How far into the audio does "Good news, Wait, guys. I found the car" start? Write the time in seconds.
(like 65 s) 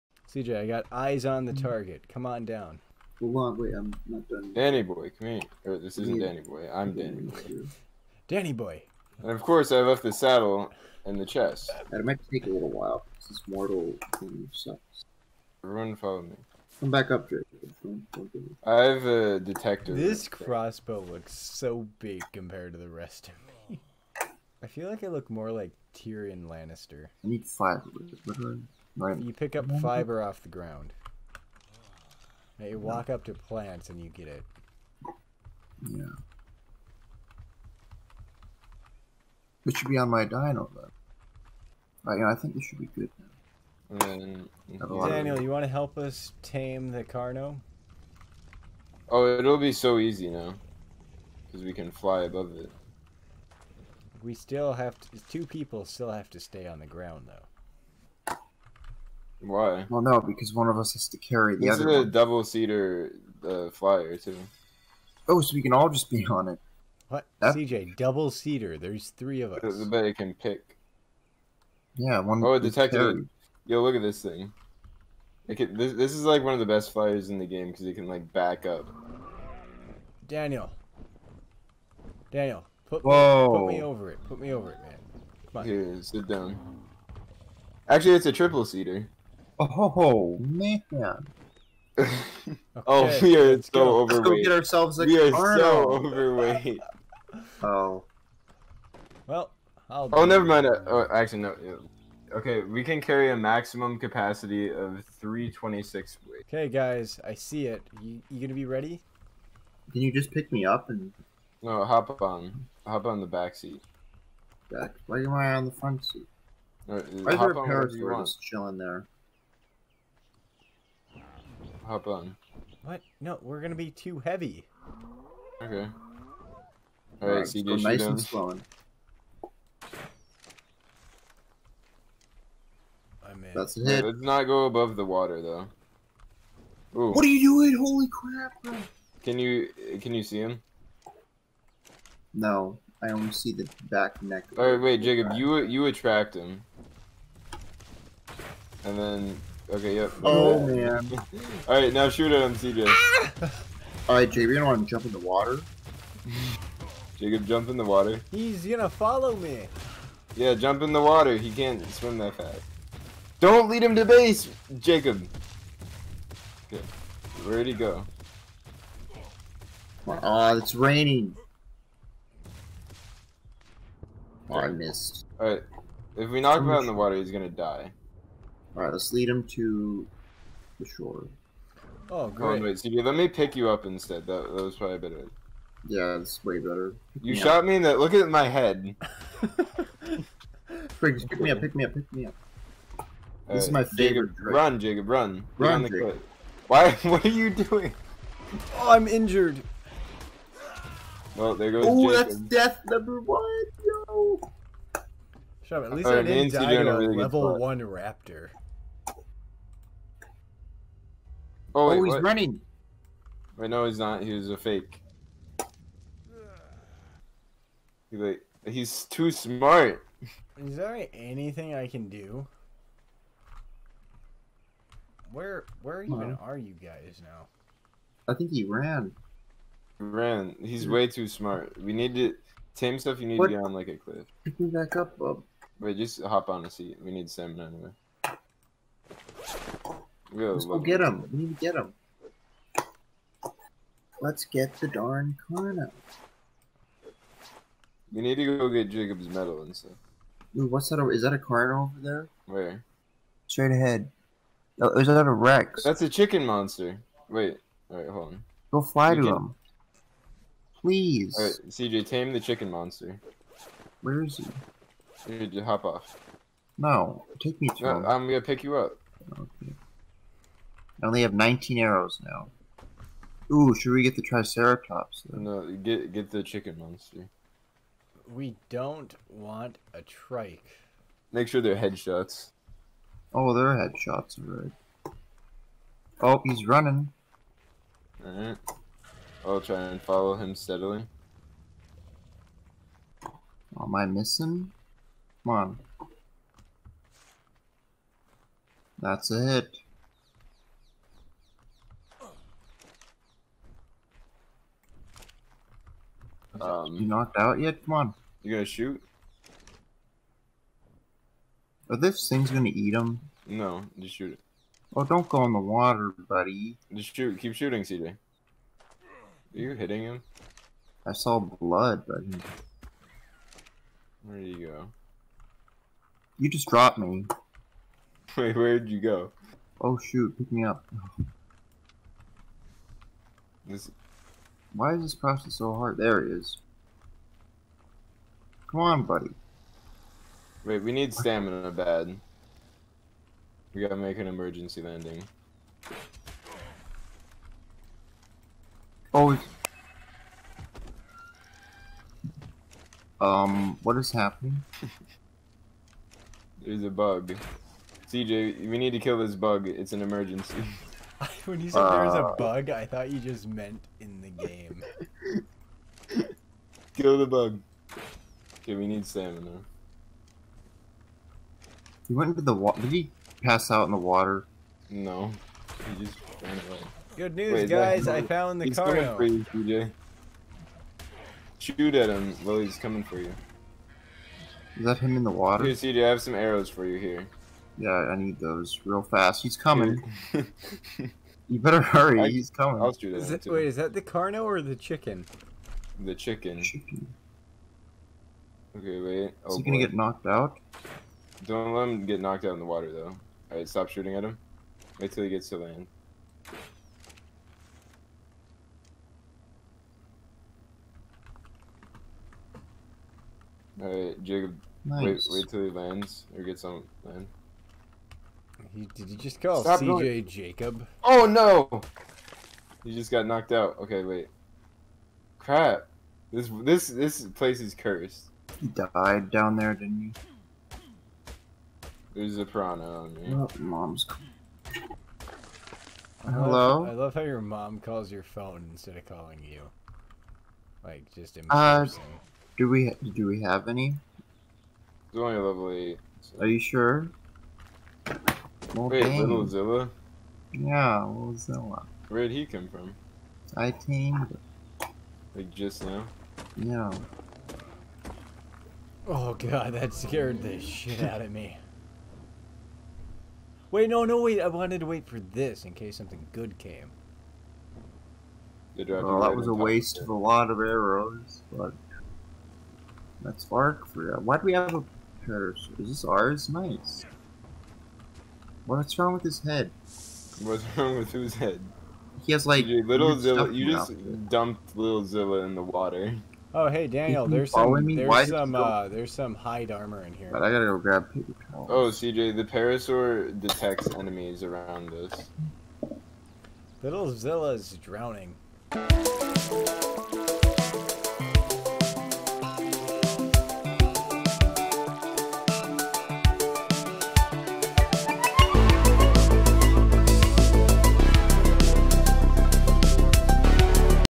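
377 s.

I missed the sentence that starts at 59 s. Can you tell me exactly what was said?
Well, no, because one of us has to carry the this other.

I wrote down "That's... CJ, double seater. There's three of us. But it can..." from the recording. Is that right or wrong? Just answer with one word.
right.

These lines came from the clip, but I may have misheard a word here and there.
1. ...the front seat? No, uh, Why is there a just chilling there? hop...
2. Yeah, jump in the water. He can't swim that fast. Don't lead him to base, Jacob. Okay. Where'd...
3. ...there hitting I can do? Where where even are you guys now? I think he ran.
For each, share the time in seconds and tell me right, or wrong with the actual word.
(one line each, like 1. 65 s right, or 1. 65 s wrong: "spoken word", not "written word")
1. 115 s right
2. 160 s right
3. 220 s wrong: "anything", not "hitting".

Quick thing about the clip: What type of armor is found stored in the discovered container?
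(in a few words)
hide armor.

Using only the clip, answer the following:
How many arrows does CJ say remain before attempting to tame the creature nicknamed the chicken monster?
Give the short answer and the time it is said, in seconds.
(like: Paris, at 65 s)
19, at 271 s.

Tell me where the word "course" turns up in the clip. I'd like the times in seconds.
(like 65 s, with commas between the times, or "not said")
9 s.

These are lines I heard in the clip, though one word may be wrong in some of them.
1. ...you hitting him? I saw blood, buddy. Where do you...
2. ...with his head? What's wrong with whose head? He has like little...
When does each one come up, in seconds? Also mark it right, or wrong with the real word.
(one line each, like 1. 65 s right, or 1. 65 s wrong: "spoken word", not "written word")
1. 319 s right
2. 479 s right.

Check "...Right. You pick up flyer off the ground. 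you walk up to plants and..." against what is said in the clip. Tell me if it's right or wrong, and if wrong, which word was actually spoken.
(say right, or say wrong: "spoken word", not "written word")
wrong: "fiber", not "flyer".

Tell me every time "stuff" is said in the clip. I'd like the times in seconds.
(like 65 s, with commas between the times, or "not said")
232 s, 249 s.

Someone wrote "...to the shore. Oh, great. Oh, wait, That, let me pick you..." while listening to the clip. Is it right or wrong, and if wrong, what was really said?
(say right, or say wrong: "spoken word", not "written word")
wrong: "Stevie", not "That".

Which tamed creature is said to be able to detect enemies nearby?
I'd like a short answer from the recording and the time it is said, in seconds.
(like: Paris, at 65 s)
parasaur, at 492 s.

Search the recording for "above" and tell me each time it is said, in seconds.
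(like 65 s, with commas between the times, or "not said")
52 s, 134 s.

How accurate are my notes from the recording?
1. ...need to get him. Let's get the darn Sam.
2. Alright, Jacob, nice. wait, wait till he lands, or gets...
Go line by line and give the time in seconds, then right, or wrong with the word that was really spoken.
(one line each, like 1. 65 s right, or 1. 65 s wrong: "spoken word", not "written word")
1. 241 s wrong: "Kana", not "Sam"
2. 413 s right.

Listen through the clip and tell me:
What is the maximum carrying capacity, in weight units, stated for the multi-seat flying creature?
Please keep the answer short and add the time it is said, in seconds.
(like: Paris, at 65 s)
326, at 105 s.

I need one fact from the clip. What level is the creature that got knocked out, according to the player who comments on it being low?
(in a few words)
8.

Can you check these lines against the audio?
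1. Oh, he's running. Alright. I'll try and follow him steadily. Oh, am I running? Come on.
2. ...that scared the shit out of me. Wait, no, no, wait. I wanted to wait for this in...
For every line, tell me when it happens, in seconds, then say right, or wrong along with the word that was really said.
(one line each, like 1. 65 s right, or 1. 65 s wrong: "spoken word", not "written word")
1. 286 s wrong: "missing", not "running"
2. 459 s right.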